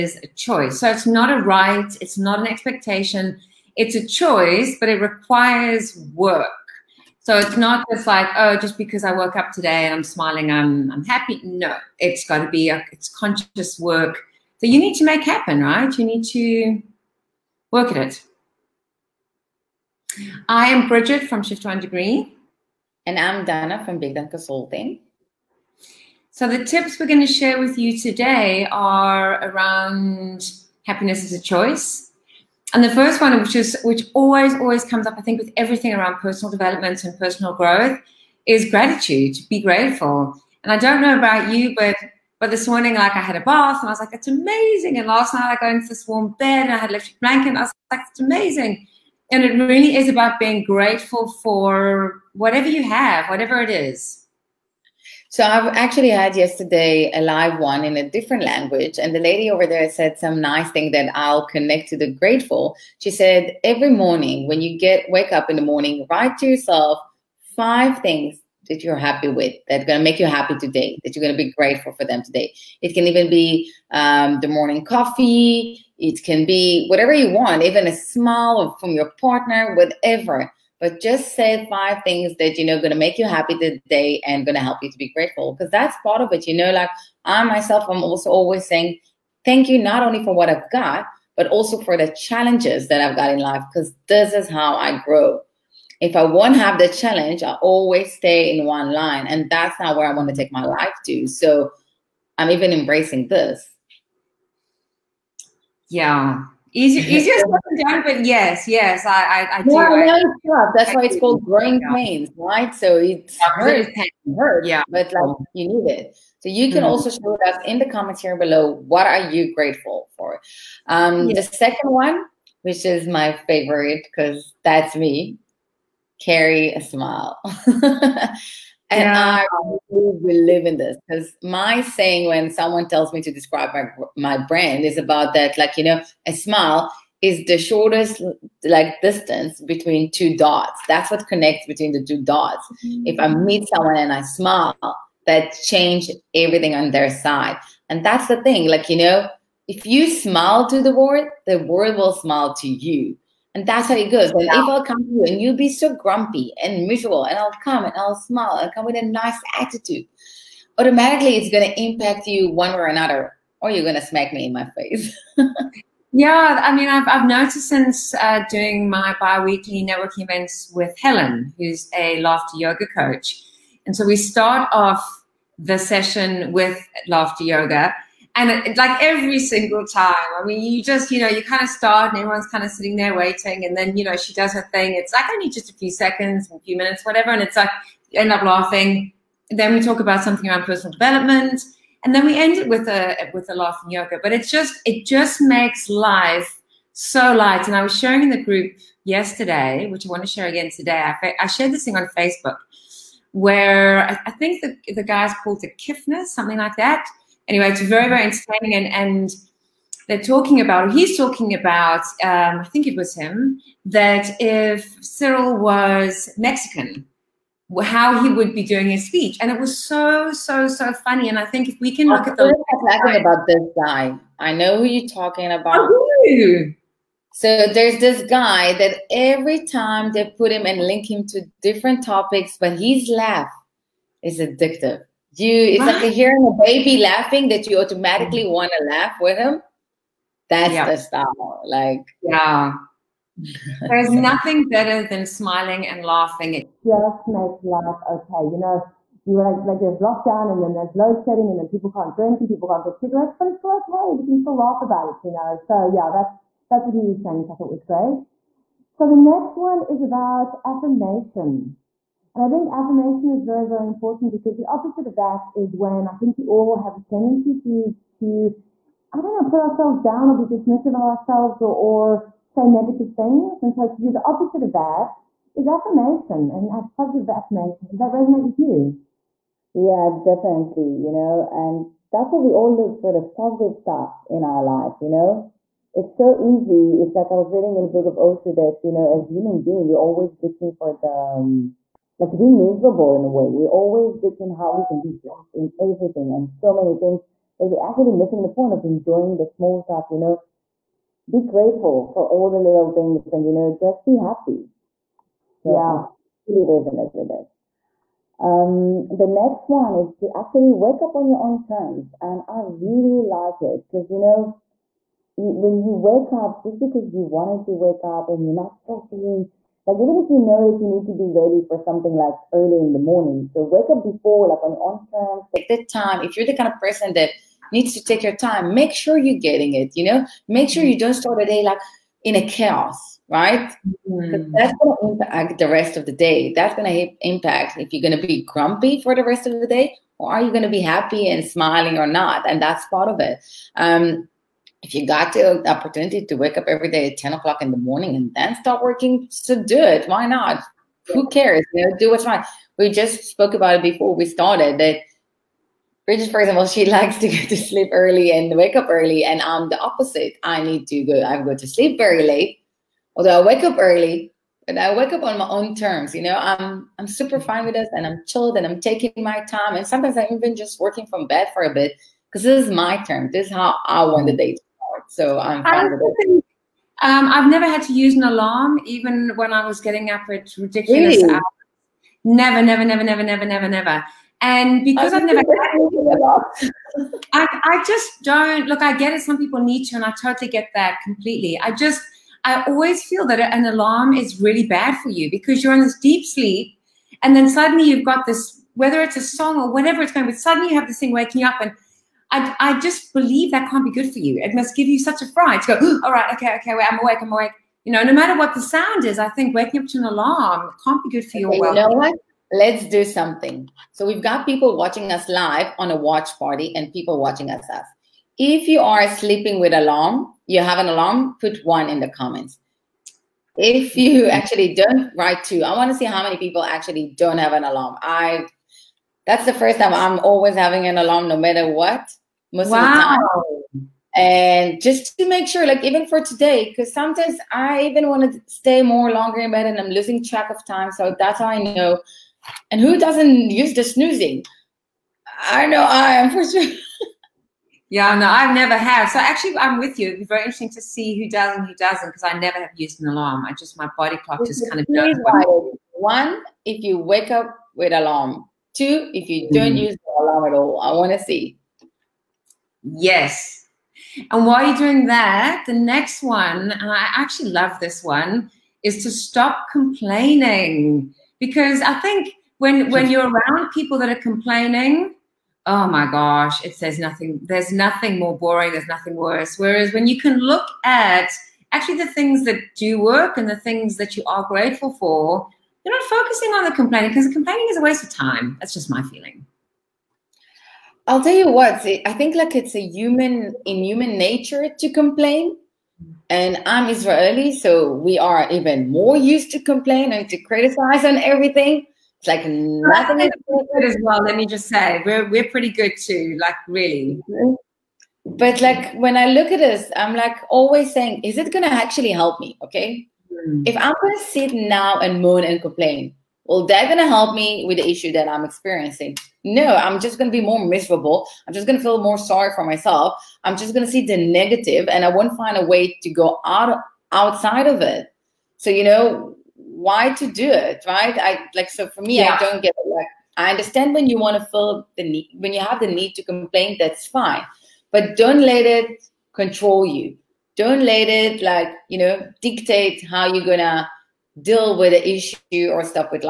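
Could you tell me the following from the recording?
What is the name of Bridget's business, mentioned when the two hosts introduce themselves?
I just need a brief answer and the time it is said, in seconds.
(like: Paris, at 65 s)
Shift One Degree, at 21 s.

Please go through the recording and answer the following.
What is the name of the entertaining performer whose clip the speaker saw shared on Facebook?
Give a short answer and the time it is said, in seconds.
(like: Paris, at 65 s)
the Kiffness, at 205 s.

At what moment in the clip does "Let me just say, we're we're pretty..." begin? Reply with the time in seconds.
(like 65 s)
504 s.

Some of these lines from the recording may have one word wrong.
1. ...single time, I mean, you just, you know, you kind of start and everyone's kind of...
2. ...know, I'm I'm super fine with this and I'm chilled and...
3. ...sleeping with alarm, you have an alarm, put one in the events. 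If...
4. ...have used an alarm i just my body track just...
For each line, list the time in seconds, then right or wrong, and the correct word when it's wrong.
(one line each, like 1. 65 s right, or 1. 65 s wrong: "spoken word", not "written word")
1. 179 s right
2. 366 s right
3. 419 s wrong: "comments", not "events"
4. 452 s wrong: "clock", not "track".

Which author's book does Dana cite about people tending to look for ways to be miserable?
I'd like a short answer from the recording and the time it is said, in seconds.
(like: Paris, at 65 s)
Osho, at 288 s.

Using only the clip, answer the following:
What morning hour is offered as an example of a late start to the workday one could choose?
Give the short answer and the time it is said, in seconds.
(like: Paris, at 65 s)
10 o'clock, at 347 s.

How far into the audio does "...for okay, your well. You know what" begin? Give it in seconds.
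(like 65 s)
411 s.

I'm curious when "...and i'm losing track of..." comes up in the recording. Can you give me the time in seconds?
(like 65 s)
439 s.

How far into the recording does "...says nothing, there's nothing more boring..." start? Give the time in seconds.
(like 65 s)
476 s.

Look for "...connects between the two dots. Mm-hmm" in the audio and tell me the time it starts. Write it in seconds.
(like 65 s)
141 s.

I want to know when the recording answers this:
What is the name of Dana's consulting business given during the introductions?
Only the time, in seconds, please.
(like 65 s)
23 s.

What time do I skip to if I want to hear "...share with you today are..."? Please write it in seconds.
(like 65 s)
27 s.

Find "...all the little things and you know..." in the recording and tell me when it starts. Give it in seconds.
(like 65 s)
302 s.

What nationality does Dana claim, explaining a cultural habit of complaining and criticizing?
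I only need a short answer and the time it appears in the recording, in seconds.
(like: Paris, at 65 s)
Israeli, at 496 s.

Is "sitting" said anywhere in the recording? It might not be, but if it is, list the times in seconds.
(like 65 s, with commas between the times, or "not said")
182 s.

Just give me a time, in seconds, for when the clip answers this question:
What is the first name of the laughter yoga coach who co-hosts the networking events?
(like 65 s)
170 s.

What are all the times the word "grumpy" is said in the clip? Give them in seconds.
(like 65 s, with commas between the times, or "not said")
155 s, 338 s.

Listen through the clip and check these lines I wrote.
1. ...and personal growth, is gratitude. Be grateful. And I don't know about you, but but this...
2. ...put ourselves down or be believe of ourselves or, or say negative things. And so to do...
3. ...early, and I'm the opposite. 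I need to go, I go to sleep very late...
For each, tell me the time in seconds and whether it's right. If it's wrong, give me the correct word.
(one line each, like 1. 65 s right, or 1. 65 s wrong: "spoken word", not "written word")
1. 37 s right
2. 269 s wrong: "dismissive", not "believe"
3. 358 s right.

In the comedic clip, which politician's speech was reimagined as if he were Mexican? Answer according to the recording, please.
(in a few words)
Cyril.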